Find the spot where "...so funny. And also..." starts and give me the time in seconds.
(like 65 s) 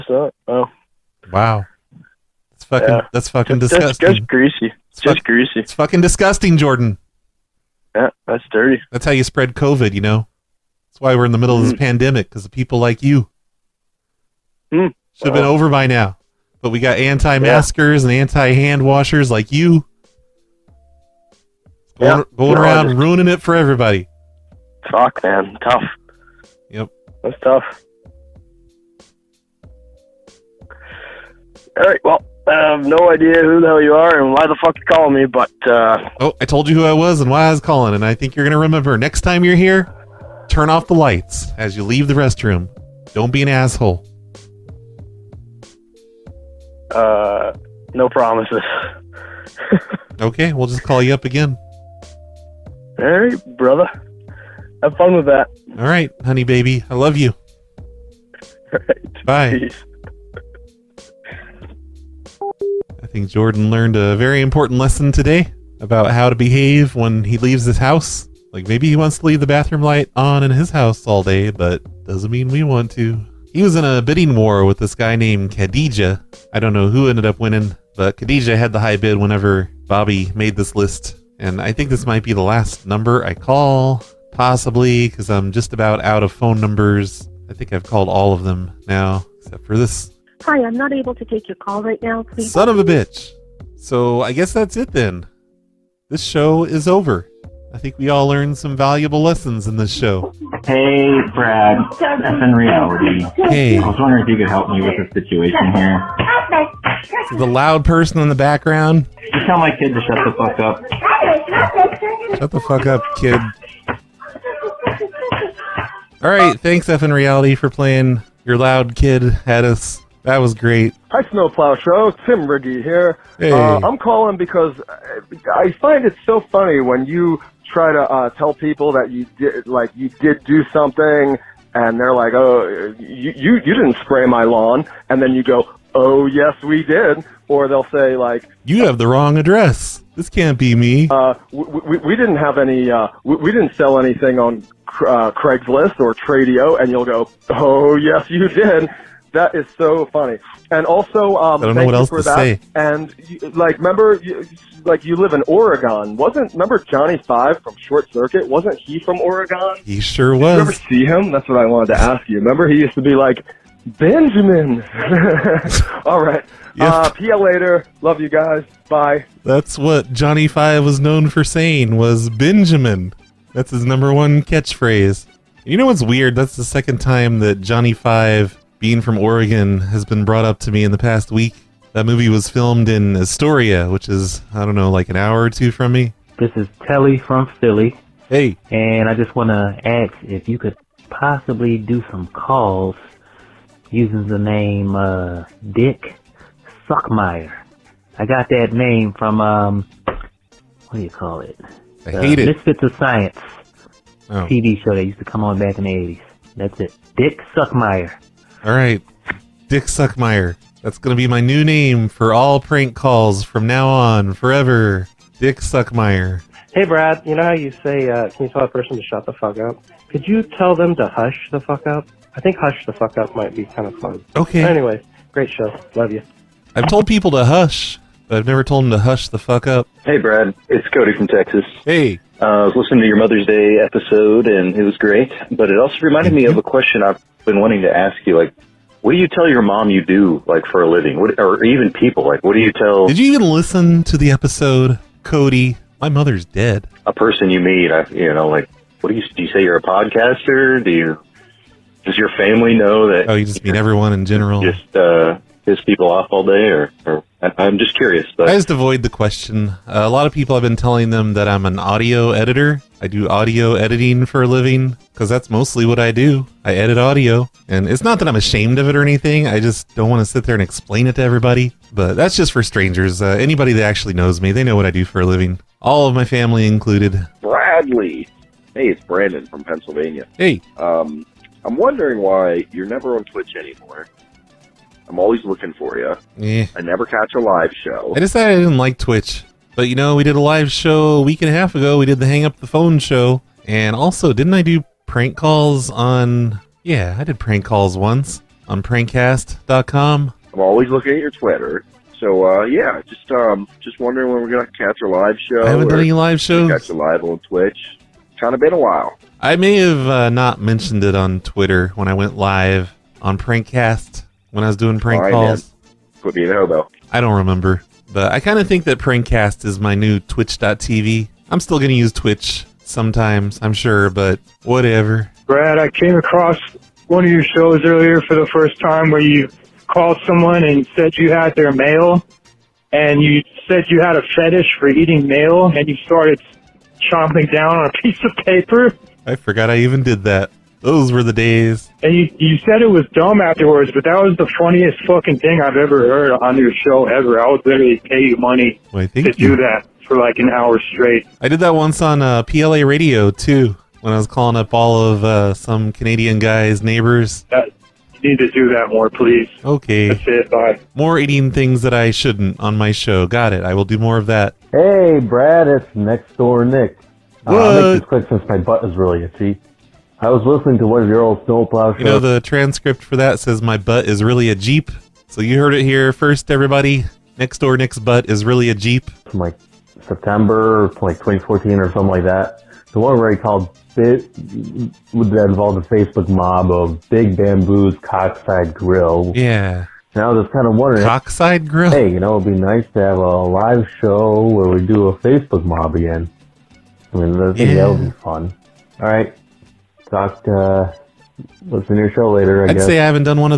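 149 s.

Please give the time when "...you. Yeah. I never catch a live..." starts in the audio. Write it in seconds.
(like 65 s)
285 s.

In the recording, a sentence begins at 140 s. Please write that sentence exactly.
This can't be me." Uh, we, we, we didn't have any.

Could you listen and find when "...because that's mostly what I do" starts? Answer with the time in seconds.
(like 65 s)
265 s.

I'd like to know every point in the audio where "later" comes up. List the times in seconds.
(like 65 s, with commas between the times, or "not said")
167 s, 402 s.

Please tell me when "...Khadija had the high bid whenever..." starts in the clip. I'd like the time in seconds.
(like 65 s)
78 s.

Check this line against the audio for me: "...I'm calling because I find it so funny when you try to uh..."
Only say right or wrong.
right.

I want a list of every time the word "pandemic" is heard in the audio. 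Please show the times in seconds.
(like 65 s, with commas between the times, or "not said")
11 s.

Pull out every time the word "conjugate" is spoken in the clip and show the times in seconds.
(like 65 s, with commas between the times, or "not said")
not said.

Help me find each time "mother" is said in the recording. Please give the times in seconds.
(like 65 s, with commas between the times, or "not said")
233 s, 246 s.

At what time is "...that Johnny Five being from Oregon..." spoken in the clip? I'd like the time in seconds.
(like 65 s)
177 s.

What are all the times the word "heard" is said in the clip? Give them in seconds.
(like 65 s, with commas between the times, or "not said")
346 s, 375 s.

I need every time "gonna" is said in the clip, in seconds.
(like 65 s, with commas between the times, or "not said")
210 s, 304 s.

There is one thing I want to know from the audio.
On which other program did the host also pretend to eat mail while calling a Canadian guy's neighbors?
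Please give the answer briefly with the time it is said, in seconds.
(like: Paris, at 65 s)
PLA radio, at 352 s.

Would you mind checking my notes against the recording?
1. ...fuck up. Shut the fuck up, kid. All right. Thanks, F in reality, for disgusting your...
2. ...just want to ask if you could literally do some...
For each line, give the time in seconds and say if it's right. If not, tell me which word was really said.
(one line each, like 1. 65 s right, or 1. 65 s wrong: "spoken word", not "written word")
1. 110 s wrong: "playing", not "disgusting"
2. 189 s wrong: "possibly", not "literally".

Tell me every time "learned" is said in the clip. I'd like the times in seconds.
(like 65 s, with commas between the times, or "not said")
63 s, 98 s.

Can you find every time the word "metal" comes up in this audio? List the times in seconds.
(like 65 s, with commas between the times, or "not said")
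not said.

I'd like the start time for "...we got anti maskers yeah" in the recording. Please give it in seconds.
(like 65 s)
16 s.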